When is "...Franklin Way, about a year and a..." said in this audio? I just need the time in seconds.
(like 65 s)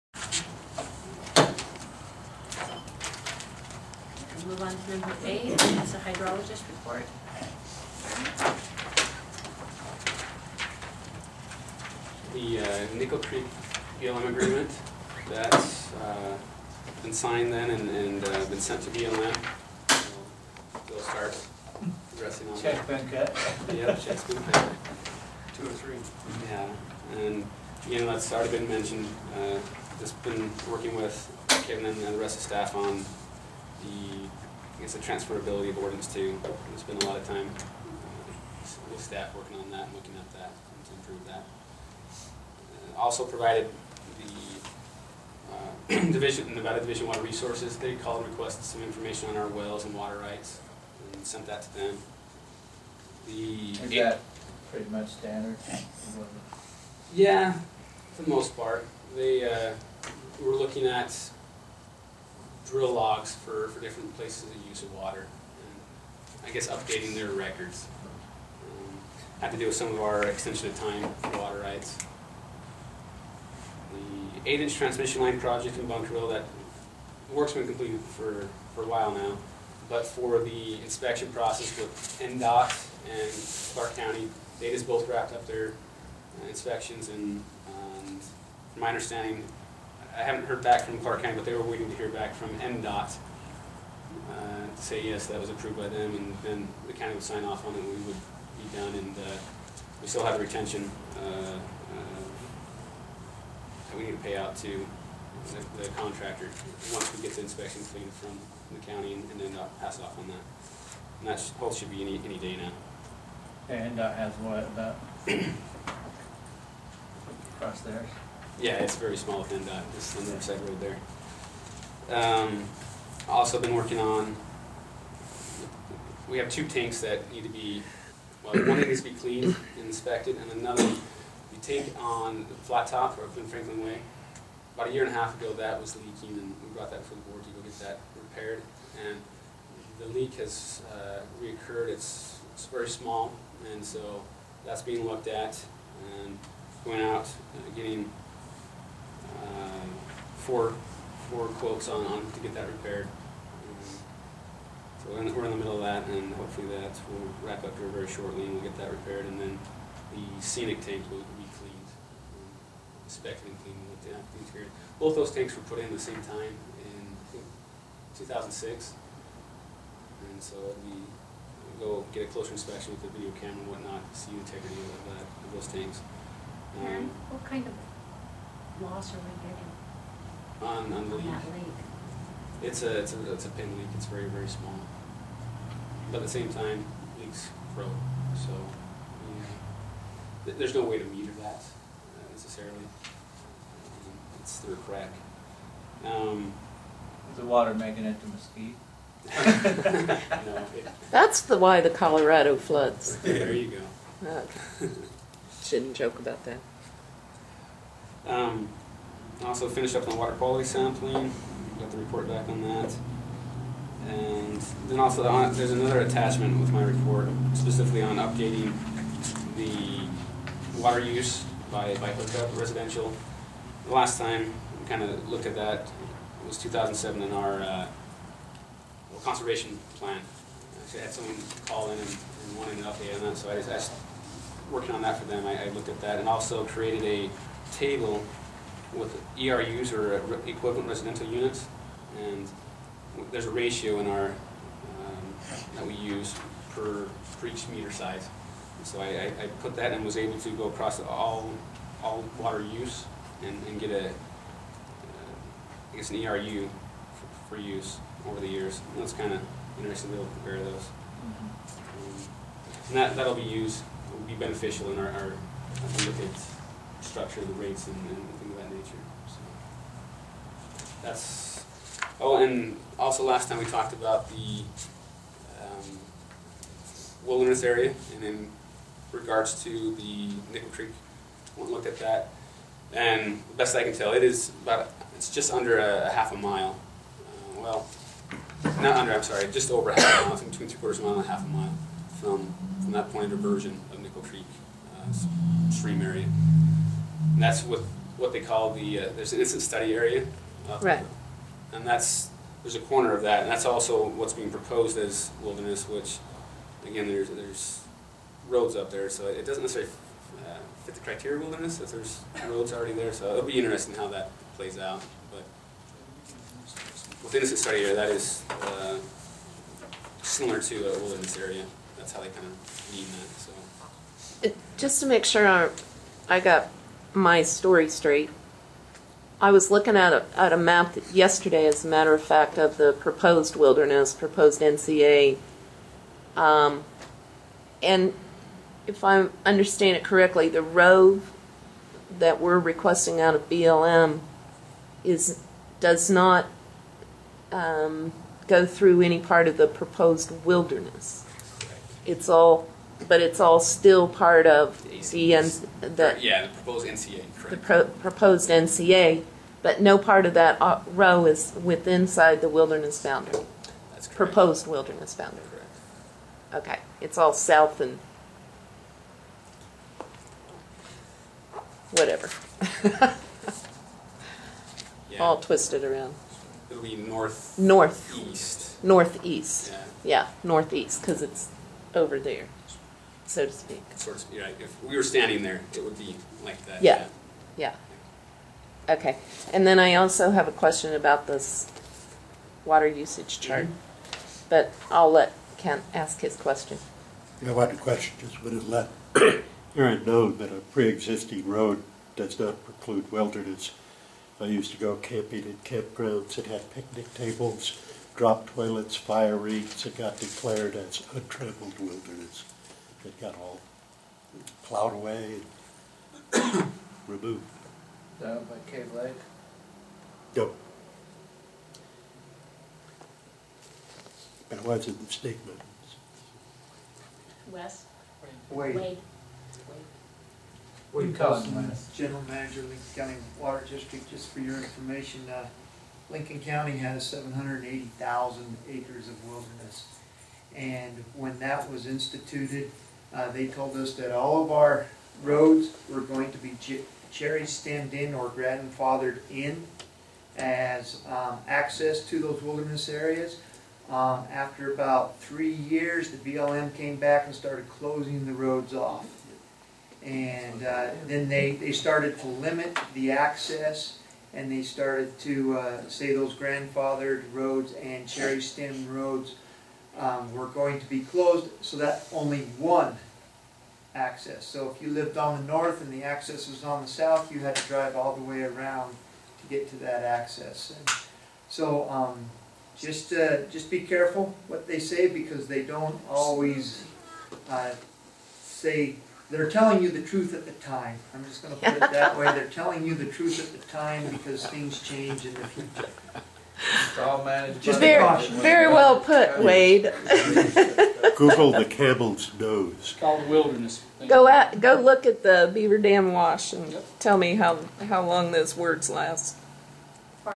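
133 s.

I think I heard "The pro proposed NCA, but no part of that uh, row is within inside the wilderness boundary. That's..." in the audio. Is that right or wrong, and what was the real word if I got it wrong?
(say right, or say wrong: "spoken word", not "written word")
right.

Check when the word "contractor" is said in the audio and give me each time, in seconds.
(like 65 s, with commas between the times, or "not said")
105 s.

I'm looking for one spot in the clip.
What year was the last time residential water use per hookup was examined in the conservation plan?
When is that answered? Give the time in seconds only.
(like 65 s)
226 s.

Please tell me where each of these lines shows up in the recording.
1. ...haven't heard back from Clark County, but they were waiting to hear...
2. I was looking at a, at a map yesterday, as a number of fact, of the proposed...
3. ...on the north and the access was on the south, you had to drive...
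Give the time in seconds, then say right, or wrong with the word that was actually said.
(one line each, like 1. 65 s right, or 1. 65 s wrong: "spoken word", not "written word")
1. 90 s right
2. 329 s wrong: "matter", not "number"
3. 475 s right.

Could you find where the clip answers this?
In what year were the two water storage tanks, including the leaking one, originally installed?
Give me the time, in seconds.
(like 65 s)
168 s.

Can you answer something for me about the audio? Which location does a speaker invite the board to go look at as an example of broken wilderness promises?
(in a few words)
Beaver Dam Wash.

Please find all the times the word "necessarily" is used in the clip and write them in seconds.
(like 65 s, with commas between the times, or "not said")
192 s, 309 s.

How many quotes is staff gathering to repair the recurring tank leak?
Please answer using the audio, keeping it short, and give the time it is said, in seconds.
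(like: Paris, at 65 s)
4, at 151 s.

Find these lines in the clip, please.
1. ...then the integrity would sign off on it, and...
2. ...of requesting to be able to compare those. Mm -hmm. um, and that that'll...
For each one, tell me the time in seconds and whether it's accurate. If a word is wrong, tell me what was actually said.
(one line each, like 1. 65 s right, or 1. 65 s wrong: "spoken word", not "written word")
1. 96 s wrong: "county", not "integrity"
2. 259 s wrong: "interesting", not "requesting".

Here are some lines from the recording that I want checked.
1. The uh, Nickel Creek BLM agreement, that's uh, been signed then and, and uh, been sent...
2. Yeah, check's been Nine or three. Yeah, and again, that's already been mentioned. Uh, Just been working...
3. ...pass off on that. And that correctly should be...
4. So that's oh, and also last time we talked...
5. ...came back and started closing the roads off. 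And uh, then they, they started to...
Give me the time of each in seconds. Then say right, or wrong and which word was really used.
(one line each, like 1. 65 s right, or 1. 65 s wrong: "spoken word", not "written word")
1. 12 s right
2. 23 s wrong: "Two", not "Nine"
3. 109 s wrong: "hopefully", not "correctly"
4. 269 s right
5. 456 s right.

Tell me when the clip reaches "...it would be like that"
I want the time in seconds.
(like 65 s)
385 s.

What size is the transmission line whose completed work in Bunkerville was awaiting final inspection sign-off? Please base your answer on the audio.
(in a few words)
8-inch.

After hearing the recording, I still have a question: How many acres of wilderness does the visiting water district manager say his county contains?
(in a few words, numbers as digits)
780,000 acres.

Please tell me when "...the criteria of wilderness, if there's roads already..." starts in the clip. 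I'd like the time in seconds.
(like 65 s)
310 s.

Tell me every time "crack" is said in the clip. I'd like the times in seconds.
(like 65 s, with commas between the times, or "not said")
194 s.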